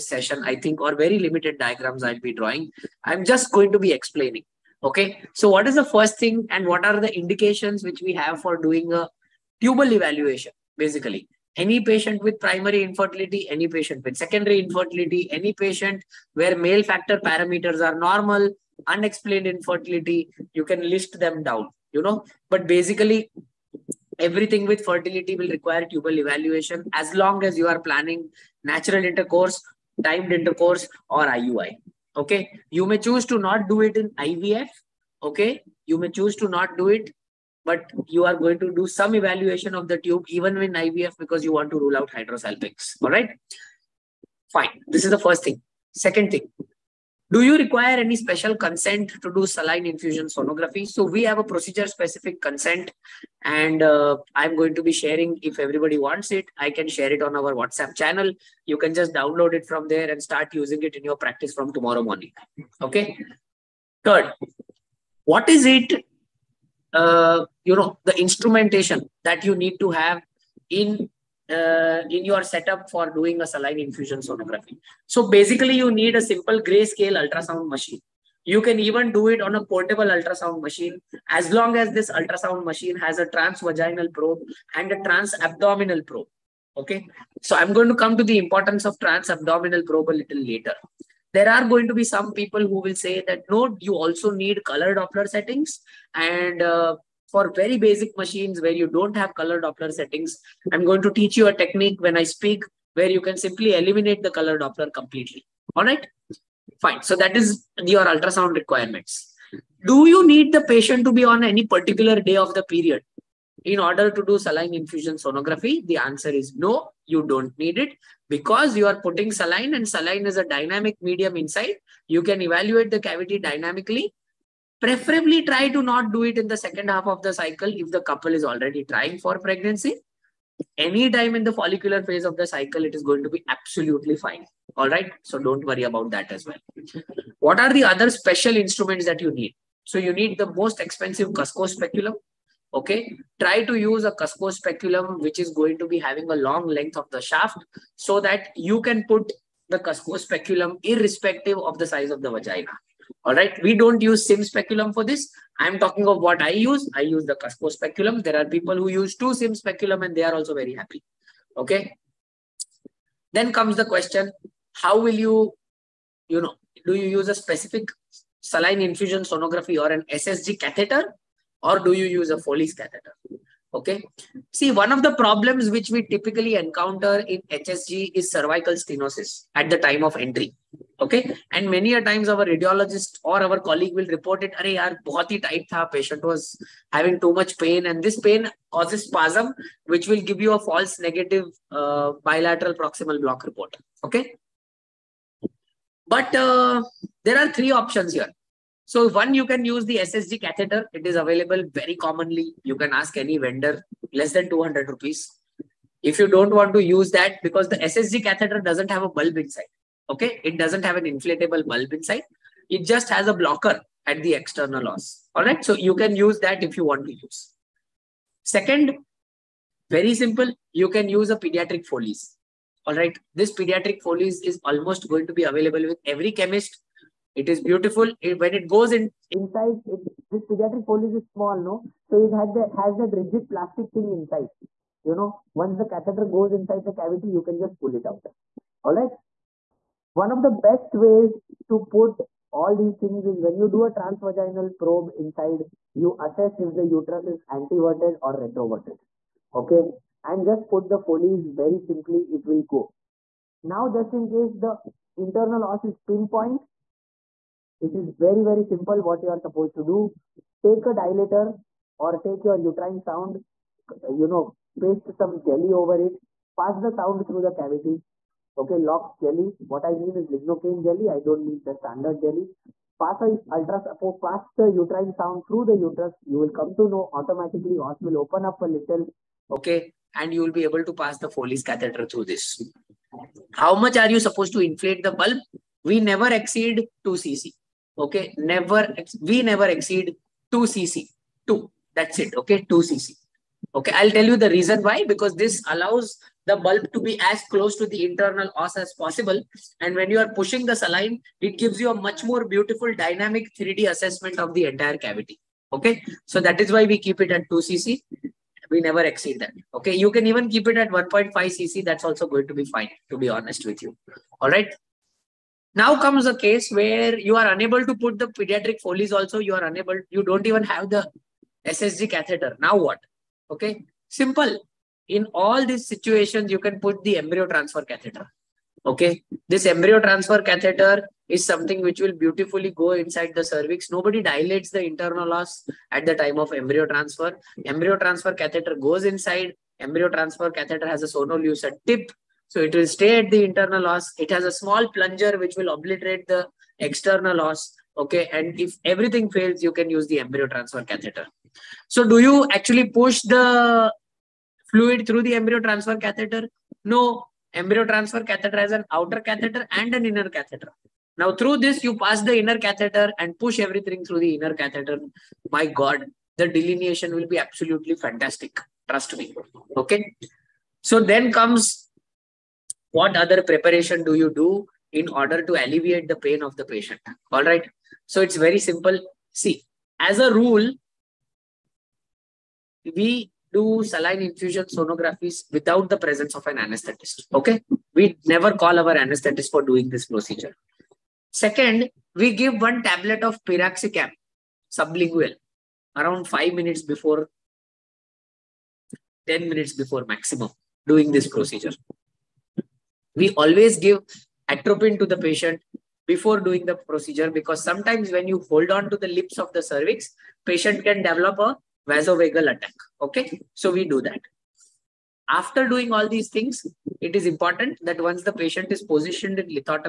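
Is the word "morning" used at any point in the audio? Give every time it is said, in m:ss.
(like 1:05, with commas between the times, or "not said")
1:02.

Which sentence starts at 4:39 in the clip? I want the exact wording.
Okay, and you will be able to pass the Foley's catheter through this.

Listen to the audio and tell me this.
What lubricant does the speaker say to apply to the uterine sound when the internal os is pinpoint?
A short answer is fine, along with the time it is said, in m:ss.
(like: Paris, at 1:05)
lignocaine jelly, at 4:30.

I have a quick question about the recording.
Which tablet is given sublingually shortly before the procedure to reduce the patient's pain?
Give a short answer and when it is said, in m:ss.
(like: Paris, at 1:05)
piroxicam, at 6:33.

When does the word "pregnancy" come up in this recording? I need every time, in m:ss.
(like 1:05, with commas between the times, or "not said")
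2:09.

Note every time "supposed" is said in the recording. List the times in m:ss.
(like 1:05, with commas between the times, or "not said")
4:19, 4:44.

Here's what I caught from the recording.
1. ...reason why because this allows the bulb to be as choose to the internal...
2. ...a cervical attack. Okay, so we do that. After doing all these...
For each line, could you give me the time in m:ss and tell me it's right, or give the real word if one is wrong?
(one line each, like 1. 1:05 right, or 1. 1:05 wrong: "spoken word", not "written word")
1. 4:54 wrong: "close", not "choose"
2. 6:51 wrong: "vasovagal", not "cervical".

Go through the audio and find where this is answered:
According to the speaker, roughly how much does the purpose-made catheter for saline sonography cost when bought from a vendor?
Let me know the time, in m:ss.
3:24.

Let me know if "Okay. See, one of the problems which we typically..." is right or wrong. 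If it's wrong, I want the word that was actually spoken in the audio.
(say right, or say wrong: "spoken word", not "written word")
right.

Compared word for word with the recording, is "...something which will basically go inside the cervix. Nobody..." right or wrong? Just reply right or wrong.
wrong.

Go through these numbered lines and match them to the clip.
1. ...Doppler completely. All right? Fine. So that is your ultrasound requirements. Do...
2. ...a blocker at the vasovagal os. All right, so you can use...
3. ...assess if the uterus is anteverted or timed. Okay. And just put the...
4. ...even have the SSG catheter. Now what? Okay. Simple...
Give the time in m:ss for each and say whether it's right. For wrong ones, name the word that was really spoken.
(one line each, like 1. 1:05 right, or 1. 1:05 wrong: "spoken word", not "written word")
1. 1:44 right
2. 3:33 wrong: "external", not "vasovagal"
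3. 4:06 wrong: "retroverted", not "timed"
4. 5:20 right.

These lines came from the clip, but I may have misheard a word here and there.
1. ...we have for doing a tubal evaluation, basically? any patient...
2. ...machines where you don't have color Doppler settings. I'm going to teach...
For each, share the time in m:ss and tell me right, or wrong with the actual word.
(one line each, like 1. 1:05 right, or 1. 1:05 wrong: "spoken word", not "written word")
1. 0:08 right
2. 1:38 right.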